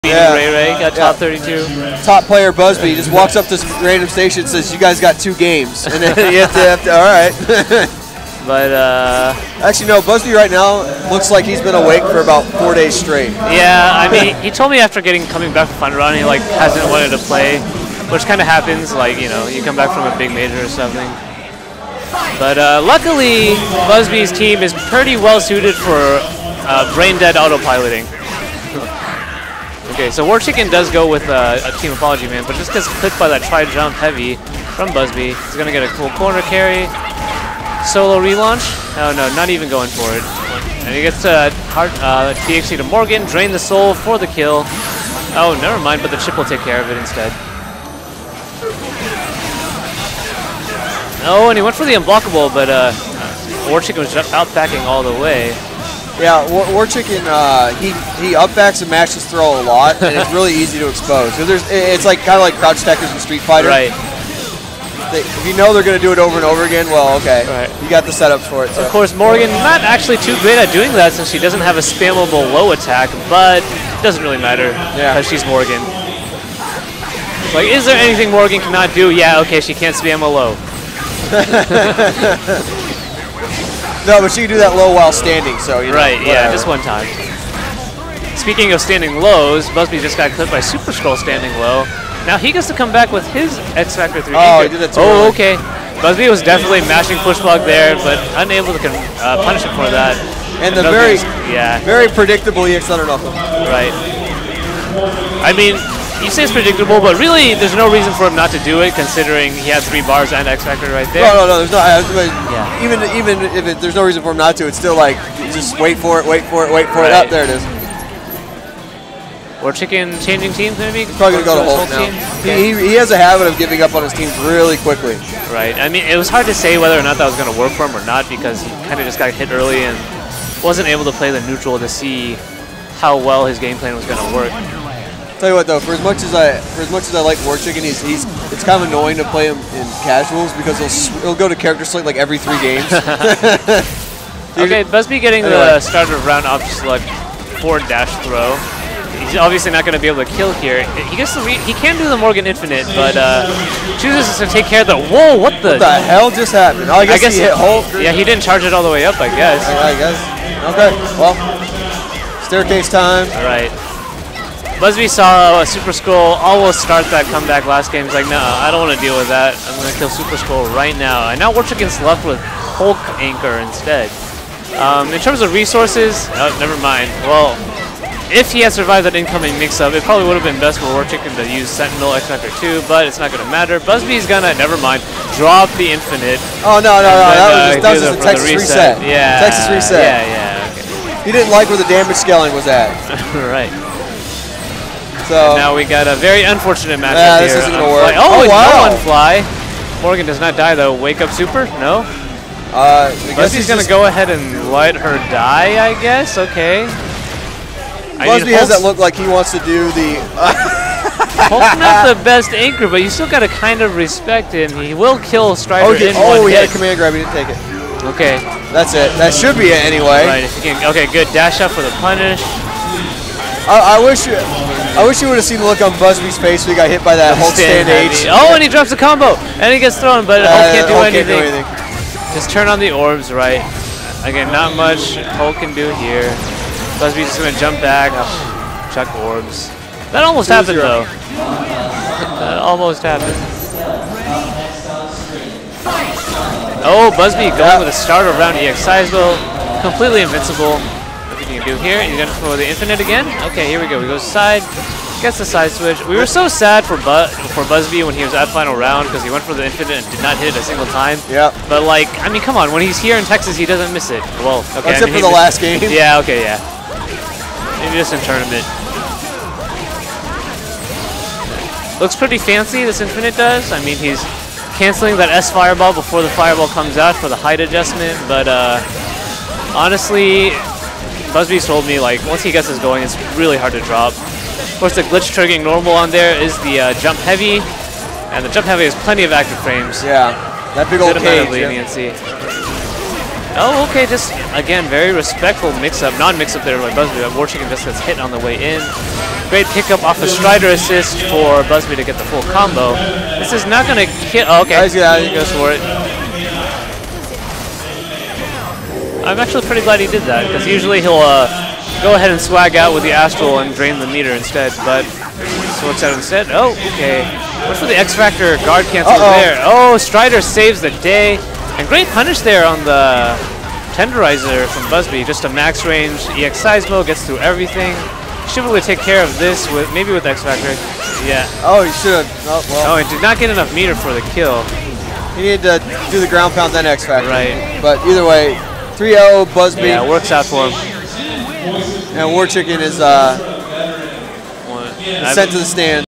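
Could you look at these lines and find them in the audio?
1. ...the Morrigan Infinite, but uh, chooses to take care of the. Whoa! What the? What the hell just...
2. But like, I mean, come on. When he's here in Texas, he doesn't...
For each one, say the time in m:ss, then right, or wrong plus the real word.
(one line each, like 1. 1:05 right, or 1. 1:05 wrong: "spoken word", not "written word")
1. 2:32 right
2. 4:21 right.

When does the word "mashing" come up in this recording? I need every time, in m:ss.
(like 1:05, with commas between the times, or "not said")
1:36.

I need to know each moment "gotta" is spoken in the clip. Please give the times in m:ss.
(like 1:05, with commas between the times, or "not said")
3:33.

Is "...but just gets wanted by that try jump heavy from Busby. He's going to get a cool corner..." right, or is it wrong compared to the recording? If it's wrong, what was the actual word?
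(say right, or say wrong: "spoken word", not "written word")
wrong: "clipped", not "wanted".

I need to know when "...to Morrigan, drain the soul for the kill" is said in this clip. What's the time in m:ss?
0:42.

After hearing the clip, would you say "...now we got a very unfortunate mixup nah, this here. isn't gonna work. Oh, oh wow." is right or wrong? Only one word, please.
wrong.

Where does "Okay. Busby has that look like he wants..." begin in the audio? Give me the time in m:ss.
3:26.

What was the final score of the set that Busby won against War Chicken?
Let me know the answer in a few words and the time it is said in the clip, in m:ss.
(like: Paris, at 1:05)
3-0, at 5:39.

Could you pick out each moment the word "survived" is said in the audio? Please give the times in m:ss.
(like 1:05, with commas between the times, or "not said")
2:58.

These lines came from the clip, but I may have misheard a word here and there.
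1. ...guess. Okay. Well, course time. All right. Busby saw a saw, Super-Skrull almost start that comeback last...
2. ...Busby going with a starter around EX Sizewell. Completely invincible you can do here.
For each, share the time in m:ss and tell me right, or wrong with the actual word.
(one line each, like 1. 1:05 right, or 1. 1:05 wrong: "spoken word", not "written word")
1. 2:39 wrong: "staircase", not "course"
2. 4:07 right.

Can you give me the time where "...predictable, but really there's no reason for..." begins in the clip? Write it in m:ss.
1:46.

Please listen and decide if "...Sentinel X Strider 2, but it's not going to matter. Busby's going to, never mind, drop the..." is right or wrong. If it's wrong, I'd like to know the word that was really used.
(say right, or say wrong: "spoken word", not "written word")
wrong: "Factor", not "Strider".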